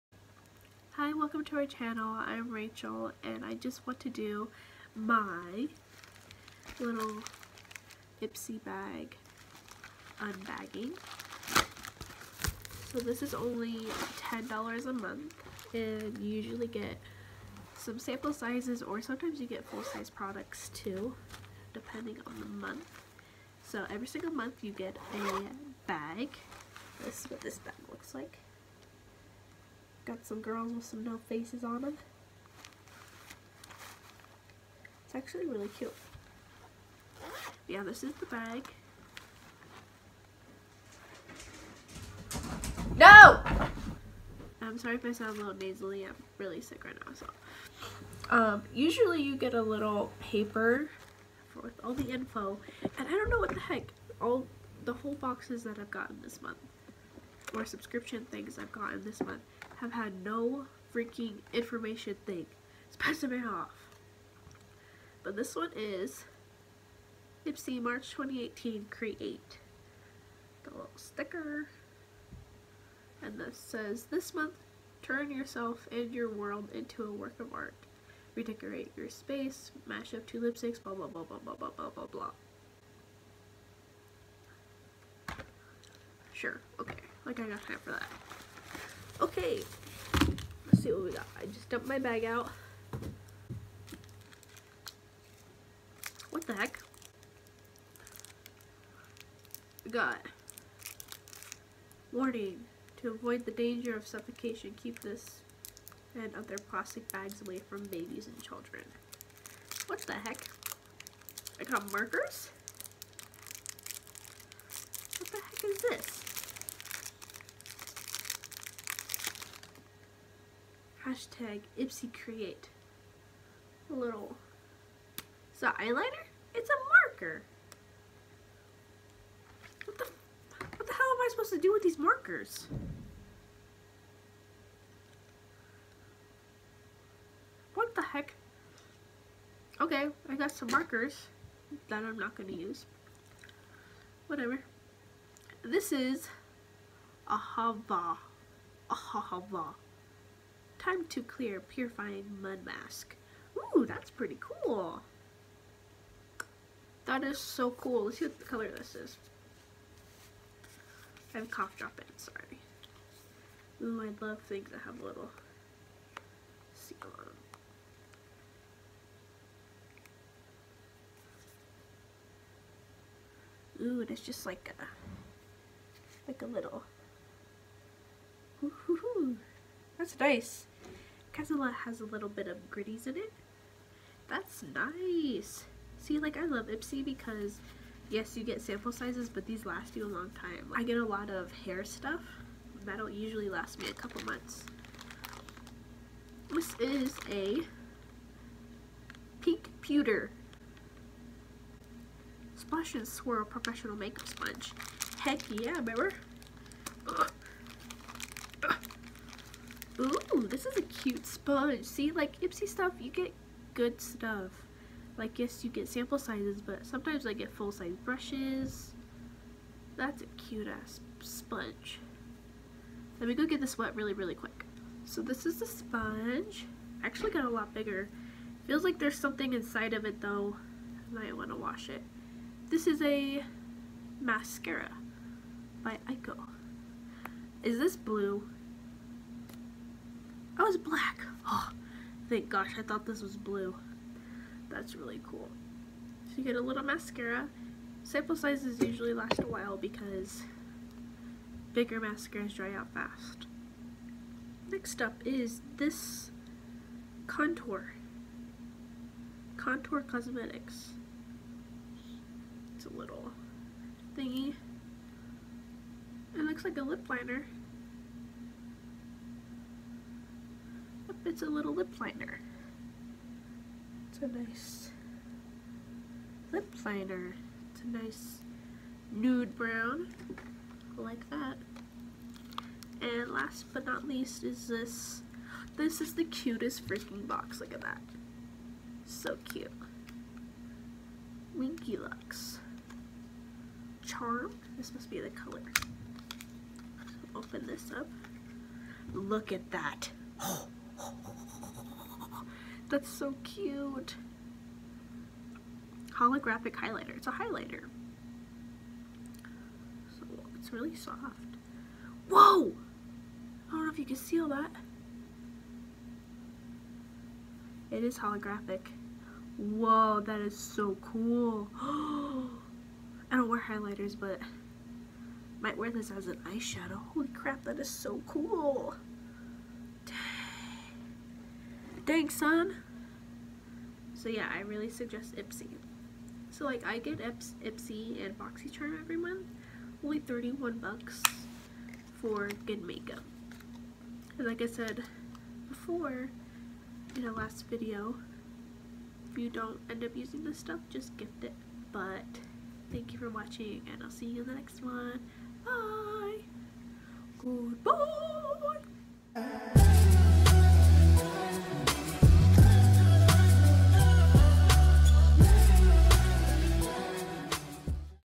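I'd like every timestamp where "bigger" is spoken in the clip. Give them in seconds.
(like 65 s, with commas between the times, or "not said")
227 s, 251 s.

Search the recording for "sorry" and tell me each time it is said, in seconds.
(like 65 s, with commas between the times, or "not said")
44 s, 162 s.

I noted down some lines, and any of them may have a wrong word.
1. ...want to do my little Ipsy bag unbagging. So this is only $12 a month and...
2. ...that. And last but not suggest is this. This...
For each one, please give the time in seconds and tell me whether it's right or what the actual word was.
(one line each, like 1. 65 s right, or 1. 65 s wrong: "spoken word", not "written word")
1. 3 s wrong: "10", not "12"
2. 281 s wrong: "least", not "suggest".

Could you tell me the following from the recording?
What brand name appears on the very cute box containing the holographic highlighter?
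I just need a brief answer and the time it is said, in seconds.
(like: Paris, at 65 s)
Winky Lux, at 291 s.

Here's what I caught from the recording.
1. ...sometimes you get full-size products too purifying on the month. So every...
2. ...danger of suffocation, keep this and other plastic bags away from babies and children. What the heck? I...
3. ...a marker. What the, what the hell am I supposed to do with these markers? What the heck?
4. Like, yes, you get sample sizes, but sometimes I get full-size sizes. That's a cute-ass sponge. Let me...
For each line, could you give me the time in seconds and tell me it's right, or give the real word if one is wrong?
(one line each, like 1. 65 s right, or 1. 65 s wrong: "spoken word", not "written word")
1. 19 s wrong: "depending", not "purifying"
2. 103 s right
3. 126 s right
4. 215 s wrong: "brushes", not "sizes".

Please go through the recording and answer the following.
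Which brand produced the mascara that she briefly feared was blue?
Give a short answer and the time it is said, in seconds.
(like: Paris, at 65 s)
Eyeko, at 236 s.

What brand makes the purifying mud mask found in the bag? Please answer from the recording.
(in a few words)
Ahava.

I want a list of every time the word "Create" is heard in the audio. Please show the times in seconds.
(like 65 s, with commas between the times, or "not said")
68 s, 122 s.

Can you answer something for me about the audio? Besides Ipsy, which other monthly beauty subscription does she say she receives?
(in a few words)
BoxyCharm.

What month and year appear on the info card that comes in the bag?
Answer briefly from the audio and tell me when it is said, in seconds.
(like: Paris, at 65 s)
March 2018, at 67 s.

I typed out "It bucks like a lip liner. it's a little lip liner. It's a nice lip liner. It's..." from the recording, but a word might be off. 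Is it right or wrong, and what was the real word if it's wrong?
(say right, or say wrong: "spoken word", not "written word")
wrong: "looks", not "bucks".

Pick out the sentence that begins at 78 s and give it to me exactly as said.
Redecorate your space, mash up two lipsticks, blah blah blah blah blah blah blah blah blah.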